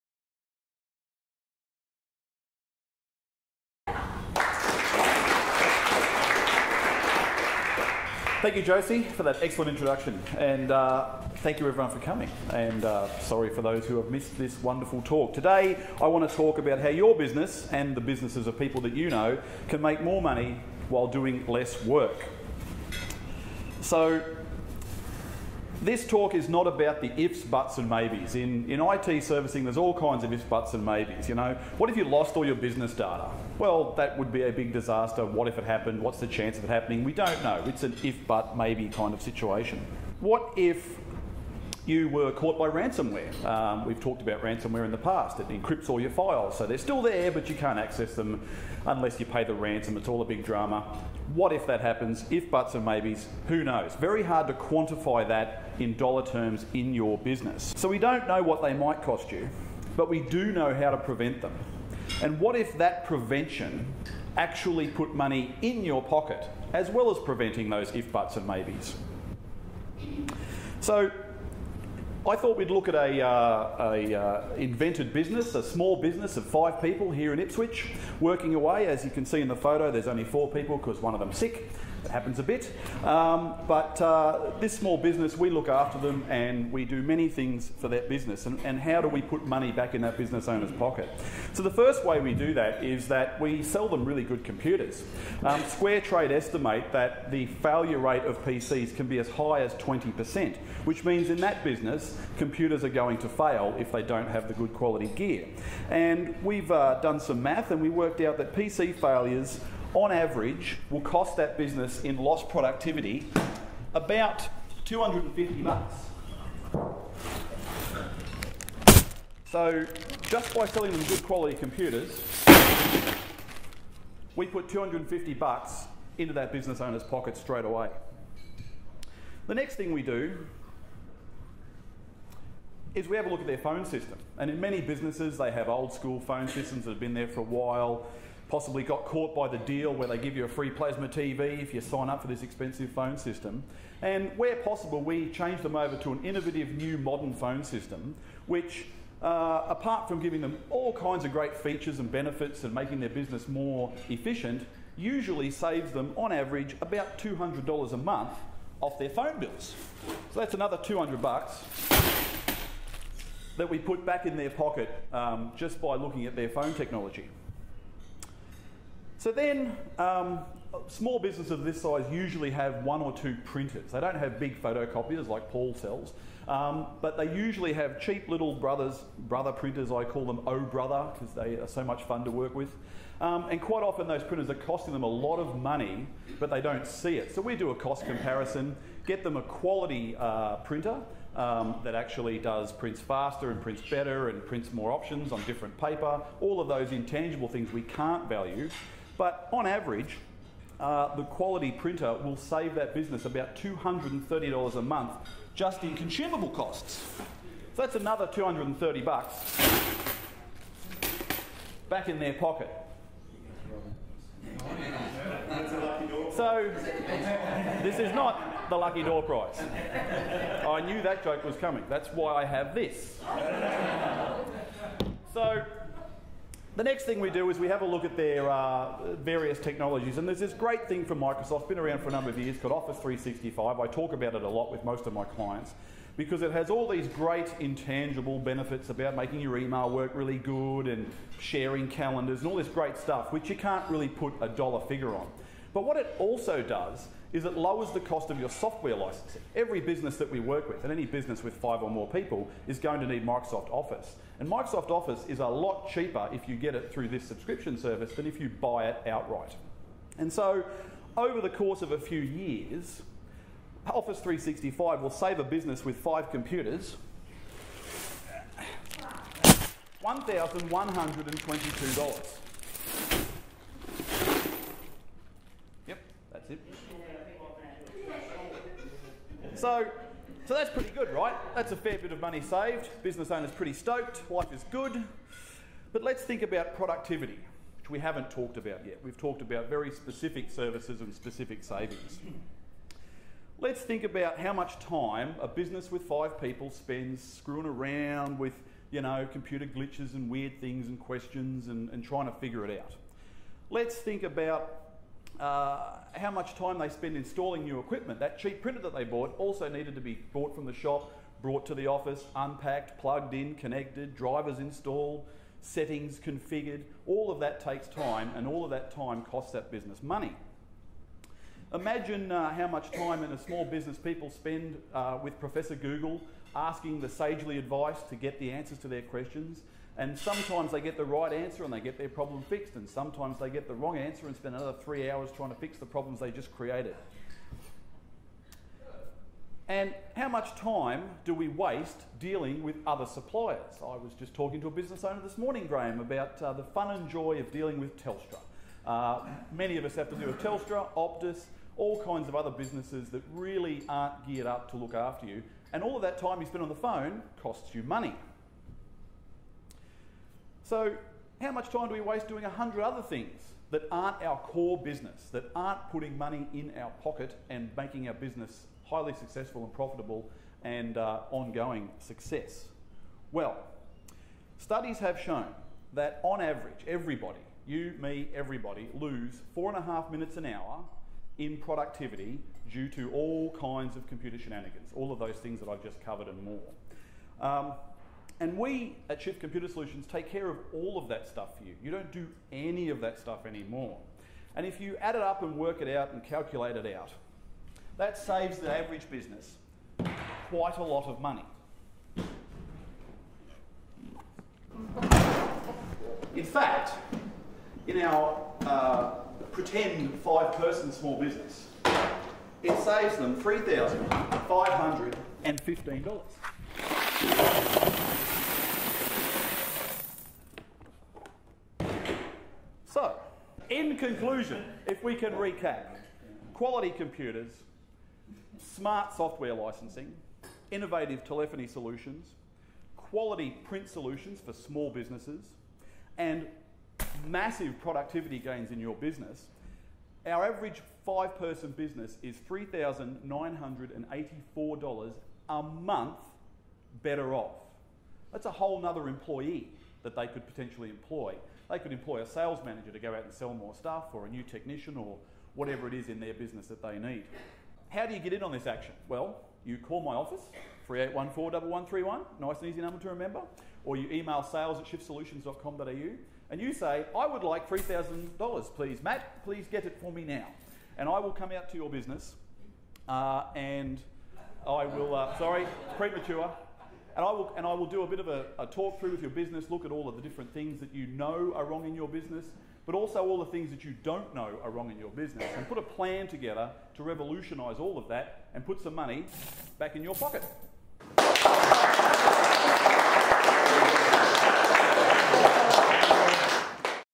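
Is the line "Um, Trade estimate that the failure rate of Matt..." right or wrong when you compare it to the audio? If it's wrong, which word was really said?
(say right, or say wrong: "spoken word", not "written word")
wrong: "PCs", not "Matt".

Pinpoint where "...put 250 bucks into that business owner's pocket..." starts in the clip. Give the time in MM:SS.
02:04.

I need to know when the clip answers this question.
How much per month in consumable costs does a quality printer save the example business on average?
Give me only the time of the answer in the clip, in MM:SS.
03:23.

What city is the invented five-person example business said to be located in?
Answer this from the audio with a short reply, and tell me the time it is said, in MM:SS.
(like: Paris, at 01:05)
Ipswich, at 01:17.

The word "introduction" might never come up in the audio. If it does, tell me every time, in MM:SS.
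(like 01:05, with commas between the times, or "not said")
00:09.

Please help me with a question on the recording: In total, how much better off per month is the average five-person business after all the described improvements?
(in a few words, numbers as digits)
$3,984.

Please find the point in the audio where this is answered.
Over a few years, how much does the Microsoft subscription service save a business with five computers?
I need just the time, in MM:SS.
04:30.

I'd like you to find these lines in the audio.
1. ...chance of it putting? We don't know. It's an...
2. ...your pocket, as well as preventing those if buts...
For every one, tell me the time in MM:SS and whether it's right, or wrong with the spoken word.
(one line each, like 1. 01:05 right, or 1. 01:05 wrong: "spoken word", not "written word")
1. 00:36 wrong: "happening", not "putting"
2. 01:05 right.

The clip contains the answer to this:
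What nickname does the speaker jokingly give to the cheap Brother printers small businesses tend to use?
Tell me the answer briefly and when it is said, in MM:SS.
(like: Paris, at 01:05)
Oh Brother, at 03:00.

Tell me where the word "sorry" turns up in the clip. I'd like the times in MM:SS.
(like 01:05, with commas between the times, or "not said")
00:13, 07:55.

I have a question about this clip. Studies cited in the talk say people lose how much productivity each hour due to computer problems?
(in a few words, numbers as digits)
4.5 minutes.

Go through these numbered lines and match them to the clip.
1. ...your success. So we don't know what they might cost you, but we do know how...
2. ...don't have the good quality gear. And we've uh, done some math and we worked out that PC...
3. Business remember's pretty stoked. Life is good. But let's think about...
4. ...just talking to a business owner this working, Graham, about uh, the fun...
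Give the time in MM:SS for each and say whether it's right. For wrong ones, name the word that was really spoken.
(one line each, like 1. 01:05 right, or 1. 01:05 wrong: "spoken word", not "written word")
1. 00:56 wrong: "business", not "success"
2. 01:44 right
3. 04:43 wrong: "owner", not "remember"
4. 05:44 wrong: "morning", not "working".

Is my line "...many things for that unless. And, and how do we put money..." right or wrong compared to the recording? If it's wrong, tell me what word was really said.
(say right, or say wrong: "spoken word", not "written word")
wrong: "business", not "unless".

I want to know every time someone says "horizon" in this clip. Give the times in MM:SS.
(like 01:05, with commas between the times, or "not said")
not said.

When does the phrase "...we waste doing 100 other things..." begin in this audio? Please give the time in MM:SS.
06:01.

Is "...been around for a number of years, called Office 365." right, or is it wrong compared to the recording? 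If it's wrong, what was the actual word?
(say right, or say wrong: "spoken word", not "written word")
right.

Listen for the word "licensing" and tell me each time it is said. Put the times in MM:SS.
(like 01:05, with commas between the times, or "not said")
04:08, 07:09.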